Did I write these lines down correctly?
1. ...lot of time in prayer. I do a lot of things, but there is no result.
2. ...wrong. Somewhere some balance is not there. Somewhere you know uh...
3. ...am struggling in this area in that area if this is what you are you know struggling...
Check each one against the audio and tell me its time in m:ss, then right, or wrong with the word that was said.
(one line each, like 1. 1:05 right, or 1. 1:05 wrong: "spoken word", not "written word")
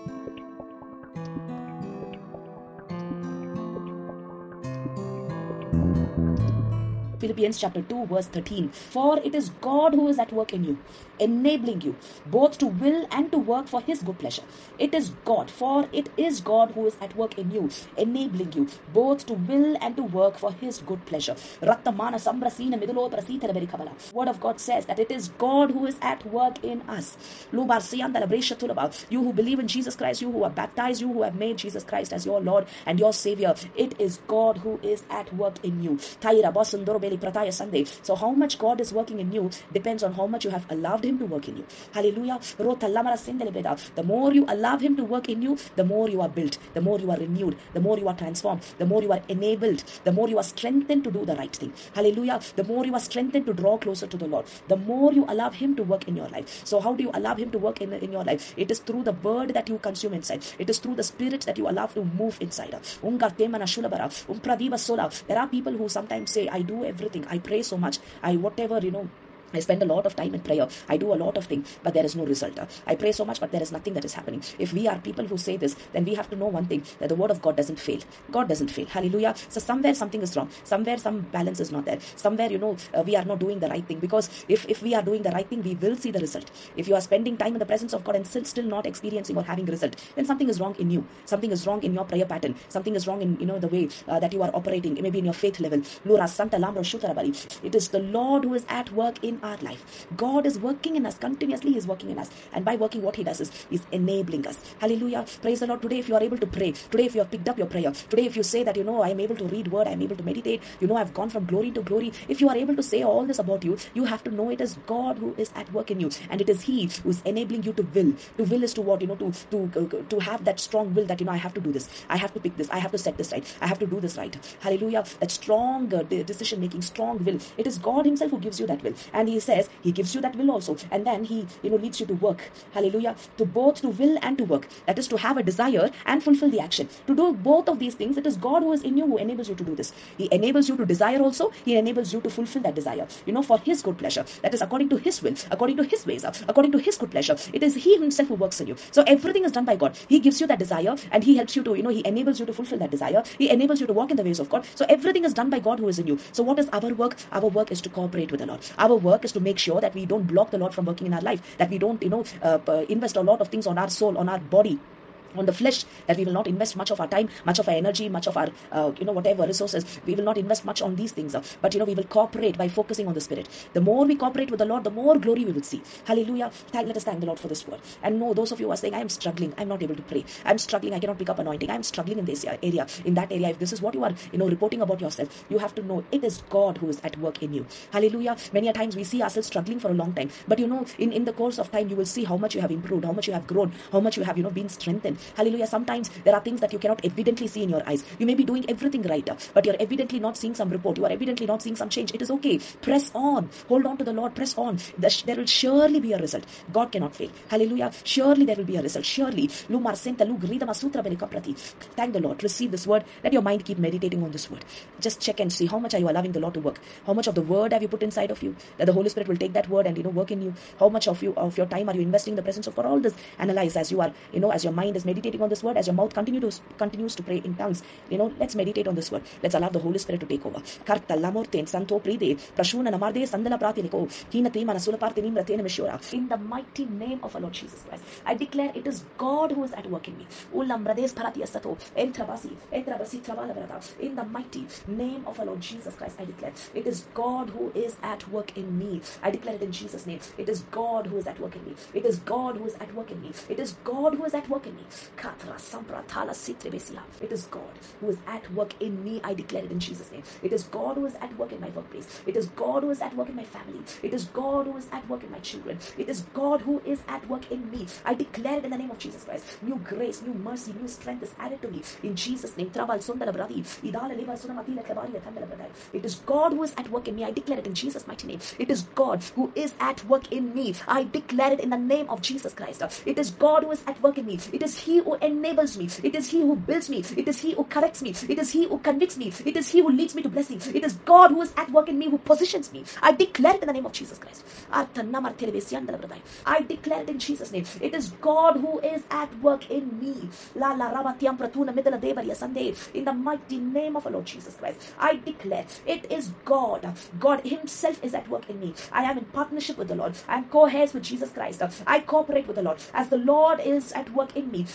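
1. 1:09 right
2. 1:20 right
3. 3:01 wrong: "reporting", not "struggling".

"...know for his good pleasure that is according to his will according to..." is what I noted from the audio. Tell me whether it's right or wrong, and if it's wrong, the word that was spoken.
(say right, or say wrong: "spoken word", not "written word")
right.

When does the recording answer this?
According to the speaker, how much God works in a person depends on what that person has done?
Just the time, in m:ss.
0:40.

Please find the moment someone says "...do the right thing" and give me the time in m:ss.
0:51.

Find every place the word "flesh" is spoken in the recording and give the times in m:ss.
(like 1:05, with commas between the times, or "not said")
2:45.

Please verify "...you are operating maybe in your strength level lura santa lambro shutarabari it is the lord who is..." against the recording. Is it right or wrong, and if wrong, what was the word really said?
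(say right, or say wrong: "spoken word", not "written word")
wrong: "faith", not "strength".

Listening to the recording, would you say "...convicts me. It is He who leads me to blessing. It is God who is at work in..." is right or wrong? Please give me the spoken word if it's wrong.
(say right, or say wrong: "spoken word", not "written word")
right.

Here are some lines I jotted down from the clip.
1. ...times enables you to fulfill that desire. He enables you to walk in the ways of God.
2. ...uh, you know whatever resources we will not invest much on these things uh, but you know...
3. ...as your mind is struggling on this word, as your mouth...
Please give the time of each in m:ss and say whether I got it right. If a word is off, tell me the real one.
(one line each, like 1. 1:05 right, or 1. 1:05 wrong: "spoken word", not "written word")
1. 2:32 wrong: "enables", not "times"
2. 2:48 right
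3. 3:44 wrong: "meditating", not "struggling".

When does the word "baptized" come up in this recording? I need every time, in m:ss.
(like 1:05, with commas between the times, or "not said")
0:30.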